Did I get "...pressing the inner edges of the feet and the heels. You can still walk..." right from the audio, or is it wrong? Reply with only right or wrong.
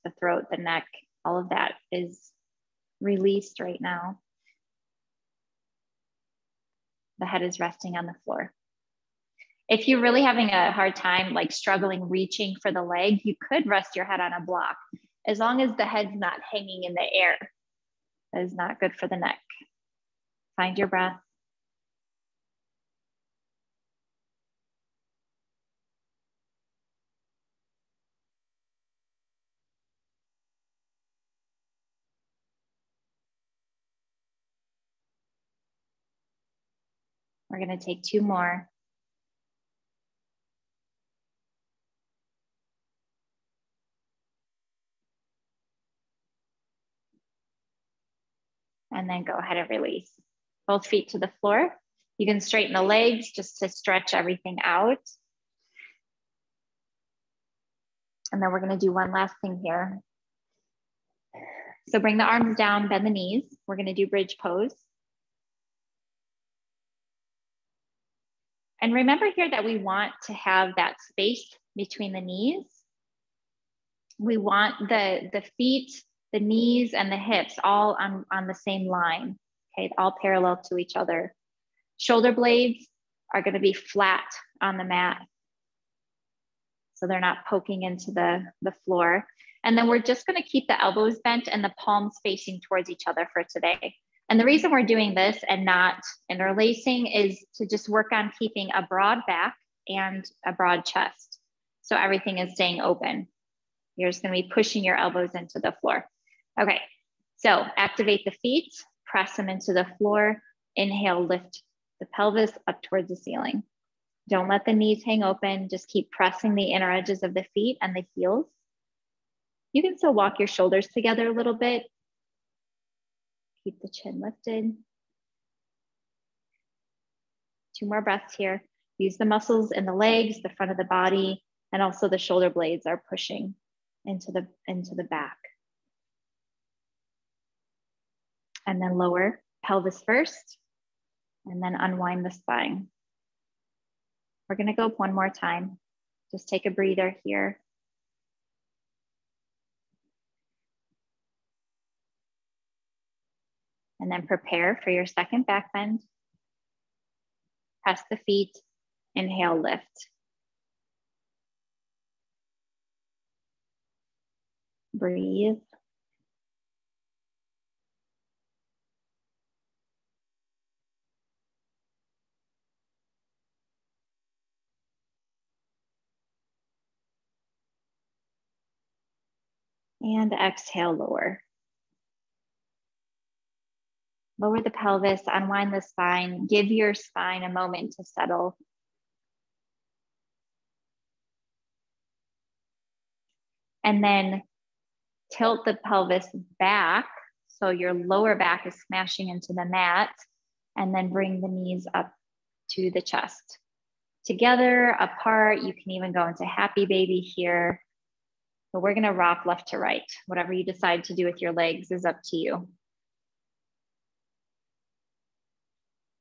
right.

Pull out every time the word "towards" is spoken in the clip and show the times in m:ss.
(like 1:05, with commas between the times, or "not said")
1:32, 1:52.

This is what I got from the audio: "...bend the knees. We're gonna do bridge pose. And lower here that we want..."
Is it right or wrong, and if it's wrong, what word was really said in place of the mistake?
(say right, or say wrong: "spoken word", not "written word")
wrong: "remember", not "lower".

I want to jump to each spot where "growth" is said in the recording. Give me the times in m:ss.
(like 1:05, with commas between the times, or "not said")
not said.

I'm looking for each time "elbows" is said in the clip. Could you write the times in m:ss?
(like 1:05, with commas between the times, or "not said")
1:30, 1:44.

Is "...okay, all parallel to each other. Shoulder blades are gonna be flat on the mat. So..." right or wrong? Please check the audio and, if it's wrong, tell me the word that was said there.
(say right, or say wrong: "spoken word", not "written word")
right.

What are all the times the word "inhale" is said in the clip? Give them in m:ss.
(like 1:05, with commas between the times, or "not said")
1:50, 2:39.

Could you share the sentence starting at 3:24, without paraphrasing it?
Together, apart, you can even go into happy baby here.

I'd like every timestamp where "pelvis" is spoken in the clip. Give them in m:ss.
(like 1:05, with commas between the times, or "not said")
1:52, 2:19, 3:04, 3:15.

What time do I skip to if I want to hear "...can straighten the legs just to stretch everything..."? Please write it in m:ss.
0:52.